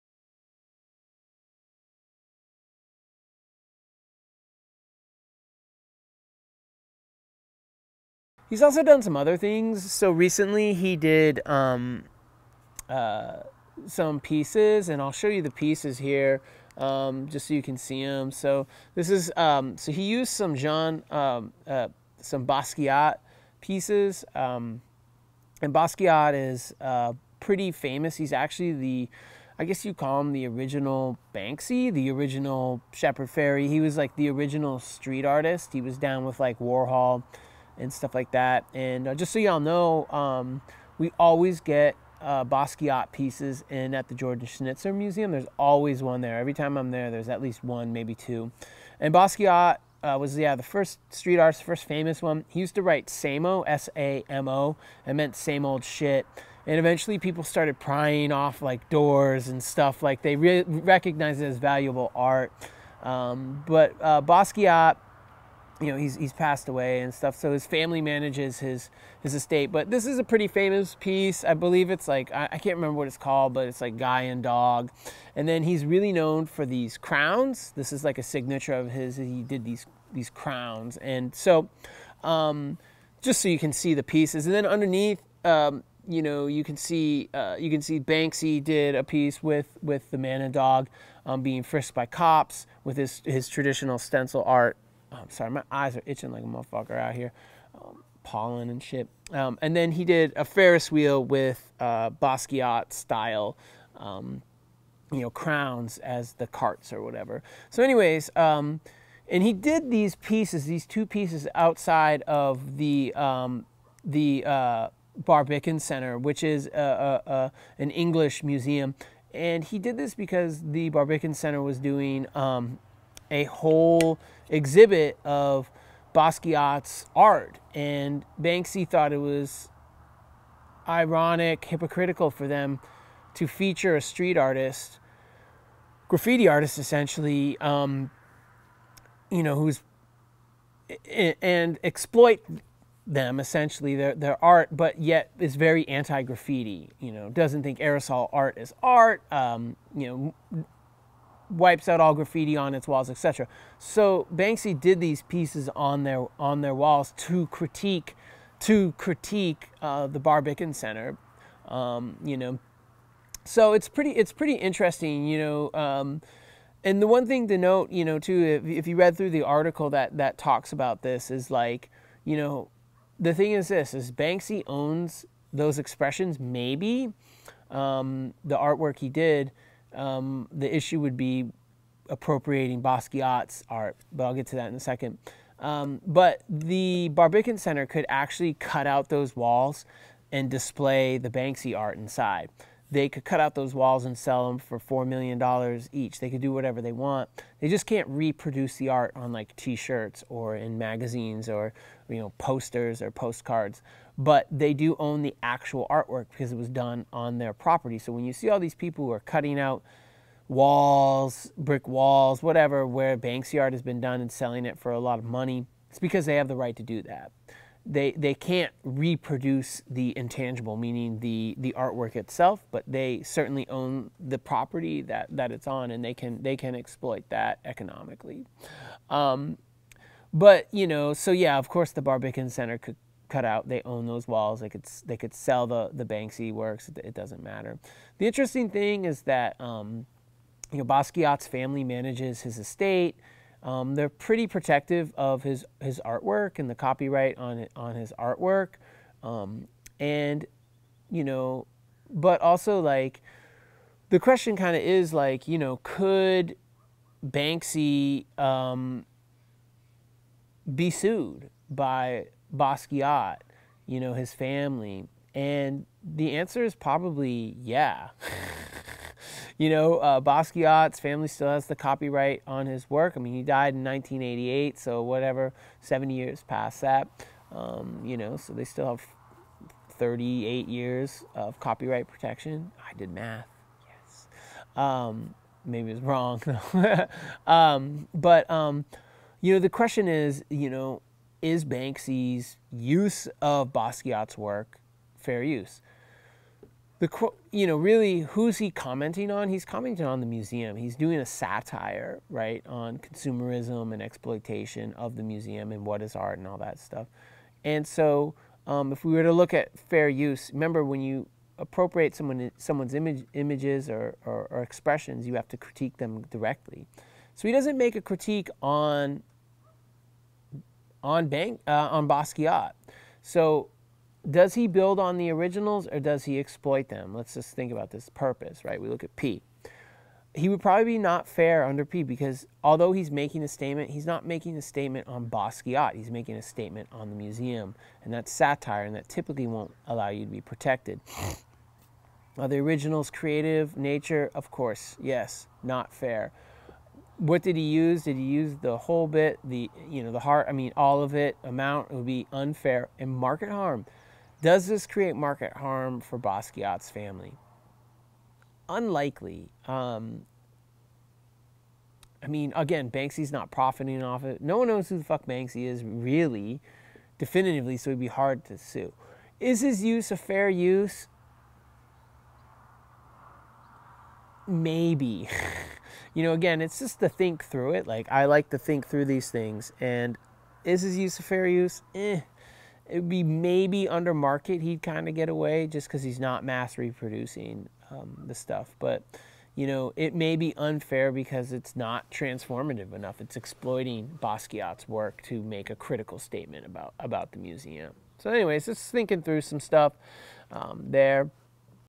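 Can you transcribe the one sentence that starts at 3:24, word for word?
But they do own the actual artwork because it was done on their property.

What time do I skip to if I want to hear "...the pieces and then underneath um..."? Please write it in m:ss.
1:23.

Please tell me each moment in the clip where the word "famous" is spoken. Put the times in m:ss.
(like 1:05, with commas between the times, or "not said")
0:27, 0:51, 1:10.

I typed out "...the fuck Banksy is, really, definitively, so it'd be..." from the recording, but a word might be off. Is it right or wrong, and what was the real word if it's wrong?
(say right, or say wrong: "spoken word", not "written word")
right.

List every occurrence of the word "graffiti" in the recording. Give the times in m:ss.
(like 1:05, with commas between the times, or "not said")
2:16, 2:26, 2:32.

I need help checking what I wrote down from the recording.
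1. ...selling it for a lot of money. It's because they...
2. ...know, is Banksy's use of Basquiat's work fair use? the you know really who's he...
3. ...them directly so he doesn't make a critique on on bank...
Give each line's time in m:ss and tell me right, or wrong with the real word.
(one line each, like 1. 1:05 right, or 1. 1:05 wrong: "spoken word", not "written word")
1. 3:34 right
2. 4:50 right
3. 5:15 right.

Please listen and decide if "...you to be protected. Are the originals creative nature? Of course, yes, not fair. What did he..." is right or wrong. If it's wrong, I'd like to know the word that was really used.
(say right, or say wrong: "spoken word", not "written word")
right.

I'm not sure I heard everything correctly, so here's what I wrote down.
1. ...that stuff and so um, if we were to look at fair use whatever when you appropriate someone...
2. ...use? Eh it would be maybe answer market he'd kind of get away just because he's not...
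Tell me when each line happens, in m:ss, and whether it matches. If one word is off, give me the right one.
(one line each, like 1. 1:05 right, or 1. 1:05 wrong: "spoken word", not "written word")
1. 5:06 wrong: "remember", not "whatever"
2. 6:21 wrong: "under", not "answer".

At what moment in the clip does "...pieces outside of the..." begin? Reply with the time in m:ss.
1:51.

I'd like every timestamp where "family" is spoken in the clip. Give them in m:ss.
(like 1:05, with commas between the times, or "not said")
1:07, 4:01, 4:24, 4:30, 5:56.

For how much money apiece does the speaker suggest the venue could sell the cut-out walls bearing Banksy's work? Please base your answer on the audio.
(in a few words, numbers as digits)
$4 million.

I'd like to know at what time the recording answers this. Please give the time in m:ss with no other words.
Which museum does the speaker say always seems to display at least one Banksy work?
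0:44.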